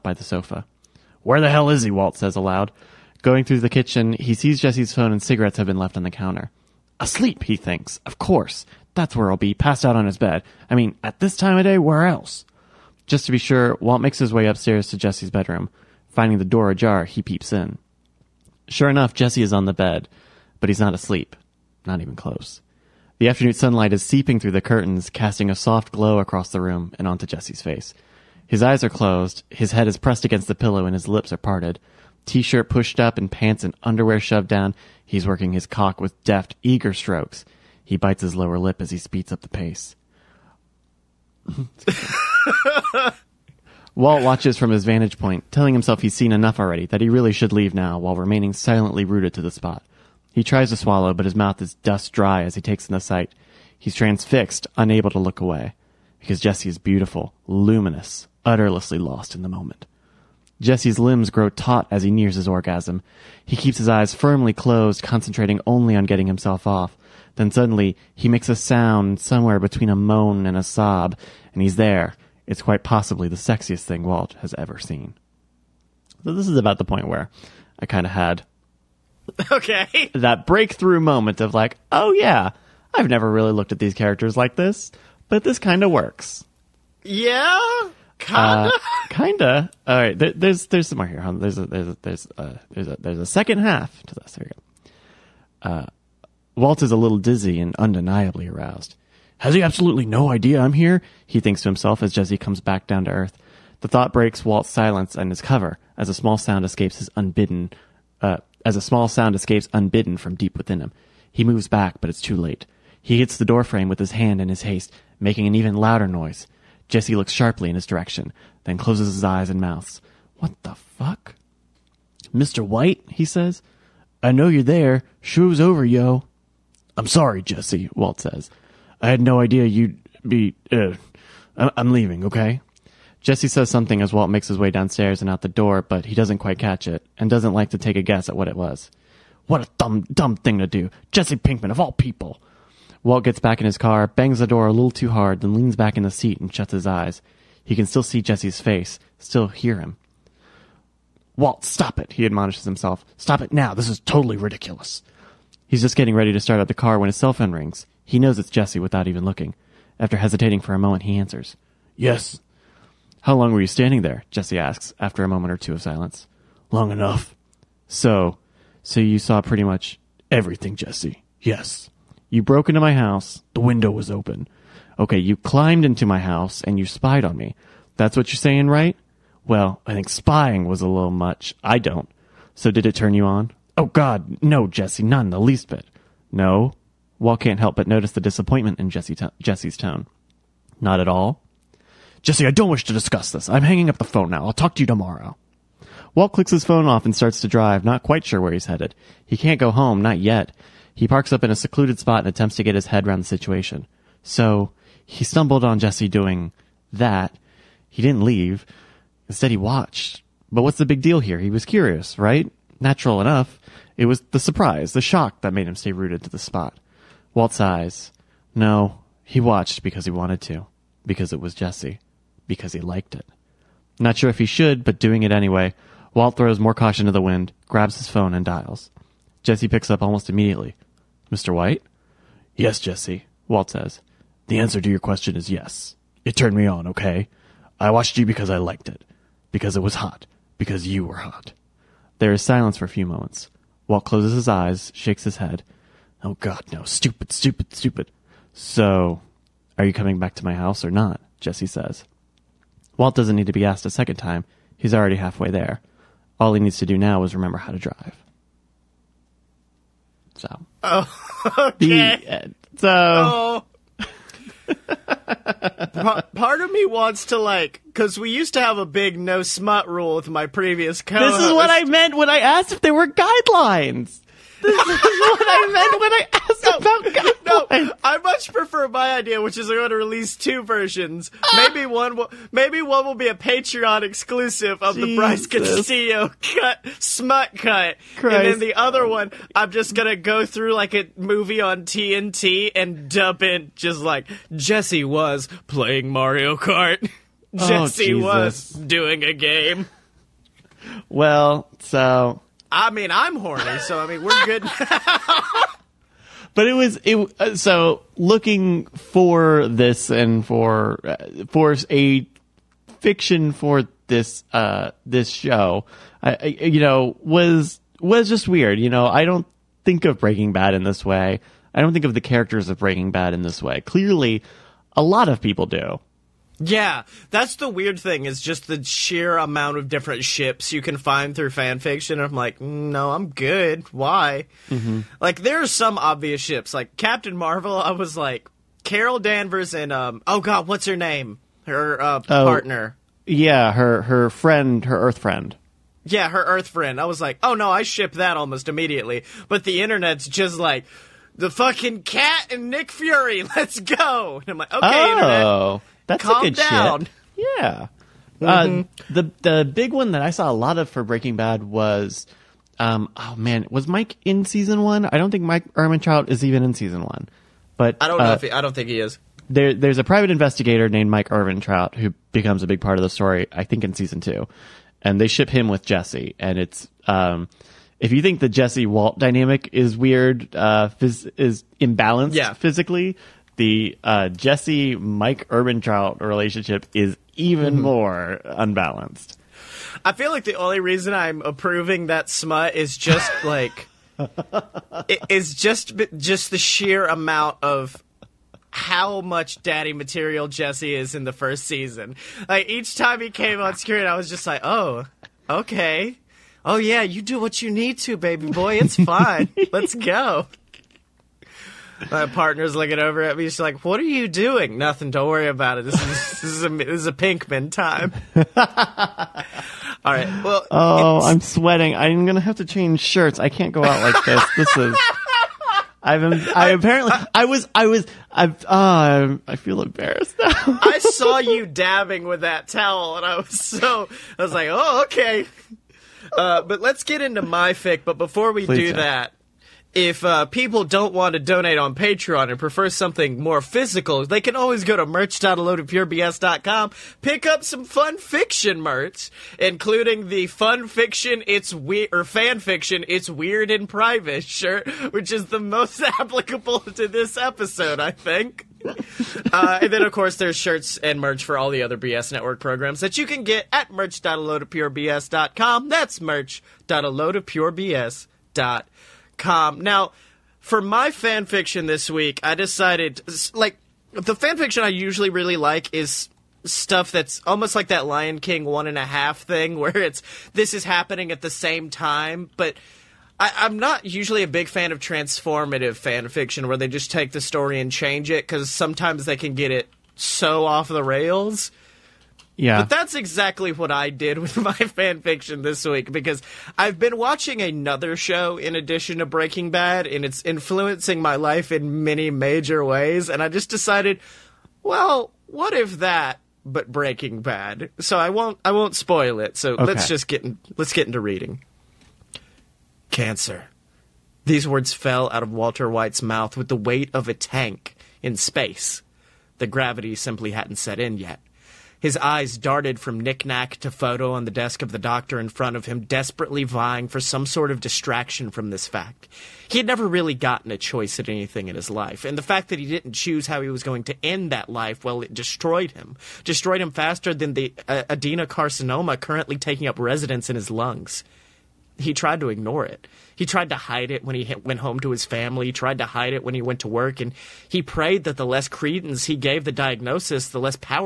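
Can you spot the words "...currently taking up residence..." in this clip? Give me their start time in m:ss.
8:59.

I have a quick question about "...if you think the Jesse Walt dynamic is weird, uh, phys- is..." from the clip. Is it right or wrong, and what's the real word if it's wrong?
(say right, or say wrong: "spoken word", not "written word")
right.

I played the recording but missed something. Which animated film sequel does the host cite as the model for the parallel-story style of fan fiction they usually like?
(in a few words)
Lion King 1 1/2.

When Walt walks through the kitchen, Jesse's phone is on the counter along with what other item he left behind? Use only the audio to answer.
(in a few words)
cigarettes.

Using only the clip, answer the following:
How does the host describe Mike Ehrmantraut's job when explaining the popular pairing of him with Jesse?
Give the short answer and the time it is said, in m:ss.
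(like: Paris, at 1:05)
private investigator, at 6:10.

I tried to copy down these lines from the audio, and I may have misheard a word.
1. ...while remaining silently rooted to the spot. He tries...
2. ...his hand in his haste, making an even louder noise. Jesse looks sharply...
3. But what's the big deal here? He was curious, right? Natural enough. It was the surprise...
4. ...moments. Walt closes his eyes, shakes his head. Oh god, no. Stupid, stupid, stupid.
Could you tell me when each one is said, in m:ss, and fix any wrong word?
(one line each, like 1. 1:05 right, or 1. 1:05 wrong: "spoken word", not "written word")
1. 0:47 right
2. 1:53 right
3. 3:30 right
4. 4:03 right.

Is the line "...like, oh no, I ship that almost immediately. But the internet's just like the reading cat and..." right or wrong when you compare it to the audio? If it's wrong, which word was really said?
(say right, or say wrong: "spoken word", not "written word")
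wrong: "fucking", not "reading".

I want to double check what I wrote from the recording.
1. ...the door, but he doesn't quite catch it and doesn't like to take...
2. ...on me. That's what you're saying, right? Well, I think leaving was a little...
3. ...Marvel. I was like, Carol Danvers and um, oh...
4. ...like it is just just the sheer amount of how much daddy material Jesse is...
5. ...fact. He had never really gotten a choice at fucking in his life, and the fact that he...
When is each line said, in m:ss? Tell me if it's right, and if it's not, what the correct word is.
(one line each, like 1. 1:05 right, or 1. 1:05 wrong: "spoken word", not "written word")
1. 2:15 right
2. 2:57 wrong: "spying", not "leaving"
3. 5:37 right
4. 6:33 right
5. 8:48 wrong: "anything", not "fucking".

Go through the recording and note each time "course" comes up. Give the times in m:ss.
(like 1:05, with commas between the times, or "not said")
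0:08, 7:40.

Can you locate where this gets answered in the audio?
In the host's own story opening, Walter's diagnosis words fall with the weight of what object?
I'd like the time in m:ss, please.
8:37.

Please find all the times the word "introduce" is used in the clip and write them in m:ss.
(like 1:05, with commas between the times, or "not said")
not said.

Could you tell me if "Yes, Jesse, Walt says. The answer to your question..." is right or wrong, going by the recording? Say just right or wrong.
right.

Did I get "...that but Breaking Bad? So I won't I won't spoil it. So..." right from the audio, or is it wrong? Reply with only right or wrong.
right.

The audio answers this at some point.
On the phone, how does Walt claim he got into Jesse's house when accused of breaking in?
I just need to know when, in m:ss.
2:53.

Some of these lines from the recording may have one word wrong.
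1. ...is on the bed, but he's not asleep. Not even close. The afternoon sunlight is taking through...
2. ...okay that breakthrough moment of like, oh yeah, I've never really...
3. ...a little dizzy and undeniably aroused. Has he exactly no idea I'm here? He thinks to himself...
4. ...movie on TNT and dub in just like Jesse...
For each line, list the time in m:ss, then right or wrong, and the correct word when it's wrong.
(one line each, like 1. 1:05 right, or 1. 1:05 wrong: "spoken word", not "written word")
1. 0:19 wrong: "seeping", not "taking"
2. 1:19 right
3. 1:36 wrong: "absolutely", not "exactly"
4. 4:51 right.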